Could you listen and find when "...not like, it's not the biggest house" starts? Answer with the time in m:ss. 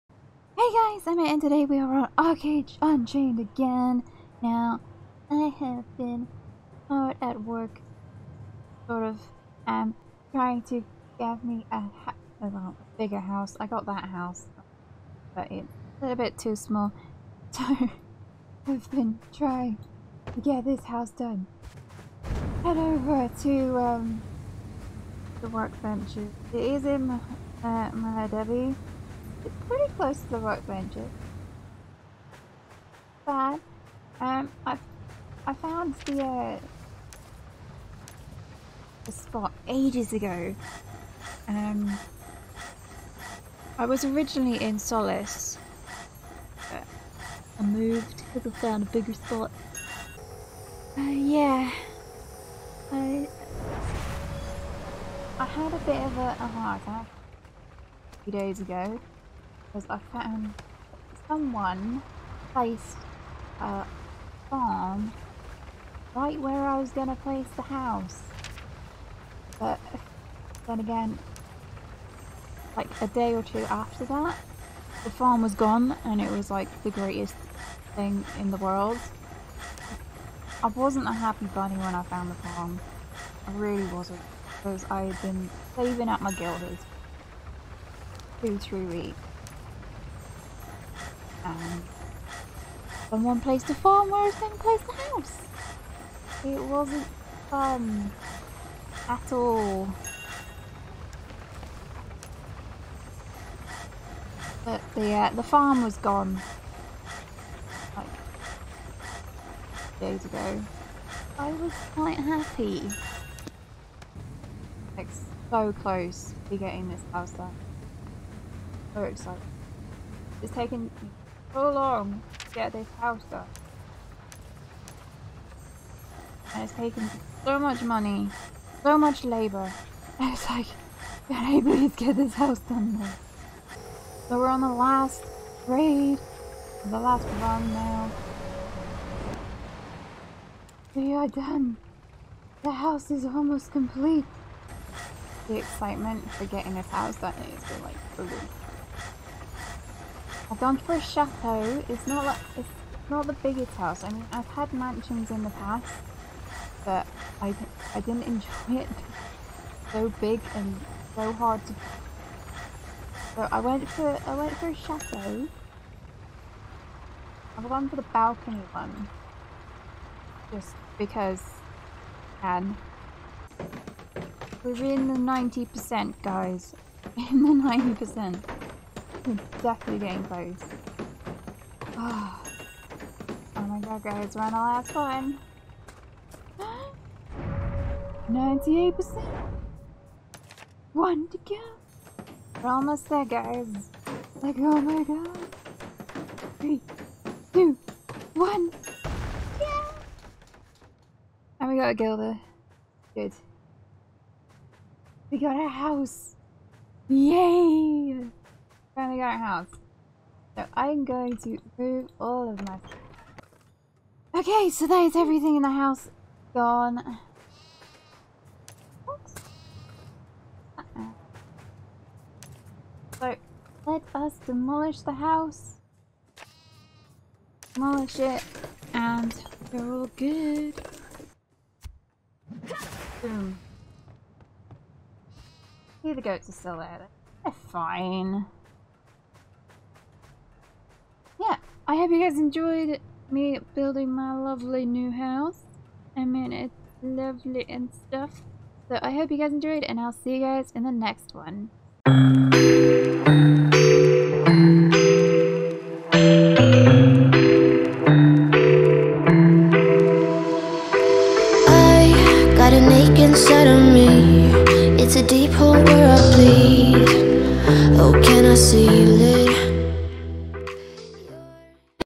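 2:32.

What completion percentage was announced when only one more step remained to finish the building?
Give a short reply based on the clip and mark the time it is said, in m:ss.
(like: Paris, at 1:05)
98%, at 3:08.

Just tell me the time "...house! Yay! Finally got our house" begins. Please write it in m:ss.
3:25.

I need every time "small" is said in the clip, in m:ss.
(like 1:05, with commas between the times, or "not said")
0:16.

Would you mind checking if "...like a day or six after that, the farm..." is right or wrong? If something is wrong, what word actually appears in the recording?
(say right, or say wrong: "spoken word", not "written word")
wrong: "two", not "six".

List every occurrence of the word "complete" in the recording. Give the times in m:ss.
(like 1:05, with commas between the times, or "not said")
2:23.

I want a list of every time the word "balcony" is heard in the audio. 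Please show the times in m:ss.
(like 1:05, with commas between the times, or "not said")
2:48.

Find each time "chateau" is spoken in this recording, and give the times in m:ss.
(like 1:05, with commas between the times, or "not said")
2:31, 2:44.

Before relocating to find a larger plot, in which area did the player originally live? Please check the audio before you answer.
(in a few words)
Solace.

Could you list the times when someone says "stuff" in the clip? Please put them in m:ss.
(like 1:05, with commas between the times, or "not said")
3:32, 4:07.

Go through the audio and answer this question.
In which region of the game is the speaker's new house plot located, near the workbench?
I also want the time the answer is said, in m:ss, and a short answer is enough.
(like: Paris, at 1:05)
Mahadevi, at 0:27.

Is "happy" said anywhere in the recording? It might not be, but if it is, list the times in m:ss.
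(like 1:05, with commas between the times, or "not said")
1:21, 1:52.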